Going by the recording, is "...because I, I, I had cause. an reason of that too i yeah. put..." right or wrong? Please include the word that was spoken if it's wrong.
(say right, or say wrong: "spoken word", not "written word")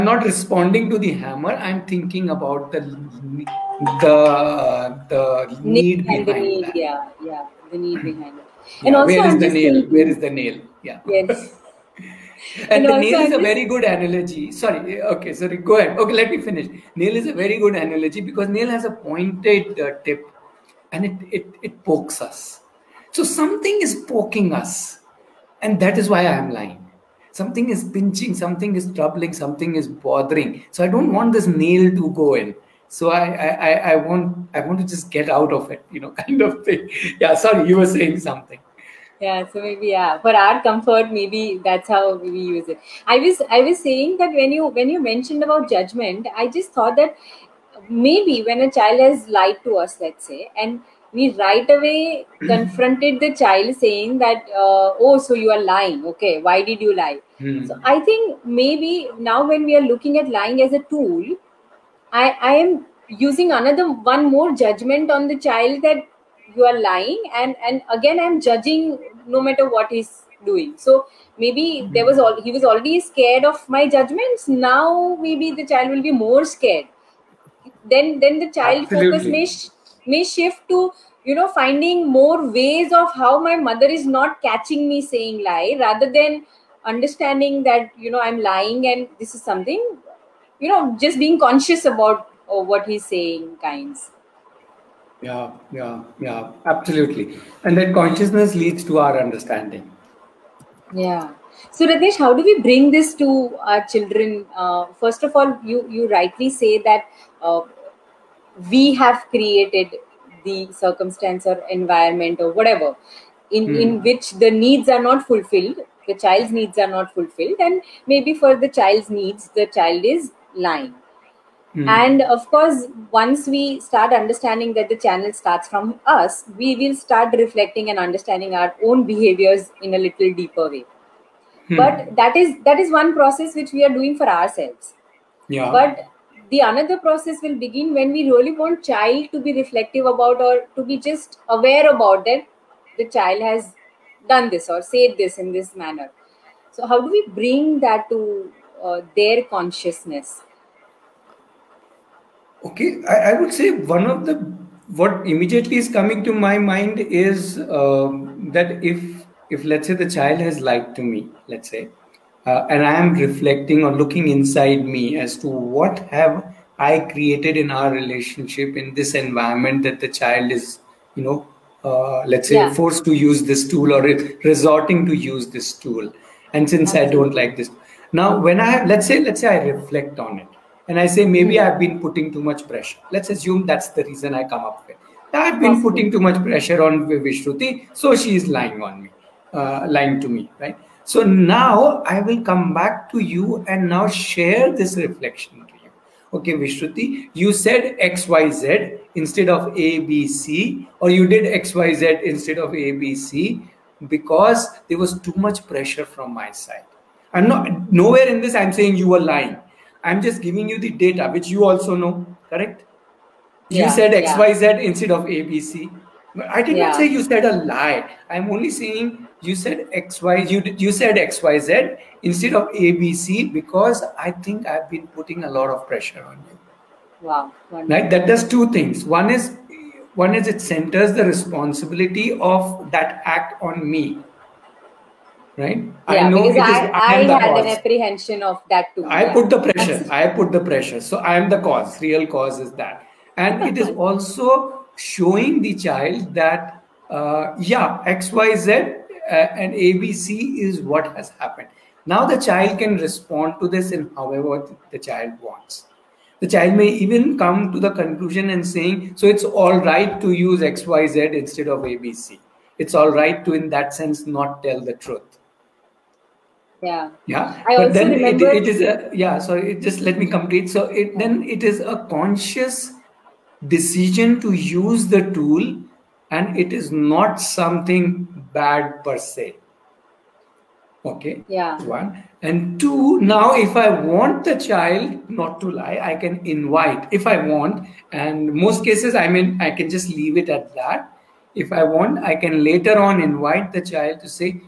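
wrong: "apprehension", not "reason".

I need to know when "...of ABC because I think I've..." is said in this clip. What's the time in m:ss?
3:42.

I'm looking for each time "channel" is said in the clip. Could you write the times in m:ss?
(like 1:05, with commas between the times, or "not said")
2:05.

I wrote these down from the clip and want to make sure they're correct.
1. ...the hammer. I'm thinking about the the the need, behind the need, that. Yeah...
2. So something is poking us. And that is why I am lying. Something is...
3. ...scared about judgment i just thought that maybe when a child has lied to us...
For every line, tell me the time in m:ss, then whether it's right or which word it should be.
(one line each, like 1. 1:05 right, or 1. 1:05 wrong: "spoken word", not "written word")
1. 0:00 right
2. 0:23 right
3. 0:45 wrong: "mentioned", not "scared".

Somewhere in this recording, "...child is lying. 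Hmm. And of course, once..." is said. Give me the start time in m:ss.
1:59.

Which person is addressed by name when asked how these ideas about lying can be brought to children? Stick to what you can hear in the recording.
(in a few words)
Ratnesh.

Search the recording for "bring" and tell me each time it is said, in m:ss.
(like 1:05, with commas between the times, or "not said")
1:42, 2:27.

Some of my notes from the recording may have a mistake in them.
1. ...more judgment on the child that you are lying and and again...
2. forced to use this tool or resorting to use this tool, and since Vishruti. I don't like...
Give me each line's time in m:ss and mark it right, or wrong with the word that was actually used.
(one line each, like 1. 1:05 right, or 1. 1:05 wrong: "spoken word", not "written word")
1. 1:04 right
2. 2:52 wrong: "Absolutely", not "Vishruti".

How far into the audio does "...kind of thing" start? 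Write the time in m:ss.
0:36.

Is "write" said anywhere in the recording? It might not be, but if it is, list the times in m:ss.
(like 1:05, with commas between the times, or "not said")
not said.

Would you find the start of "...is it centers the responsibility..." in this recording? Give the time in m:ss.
3:50.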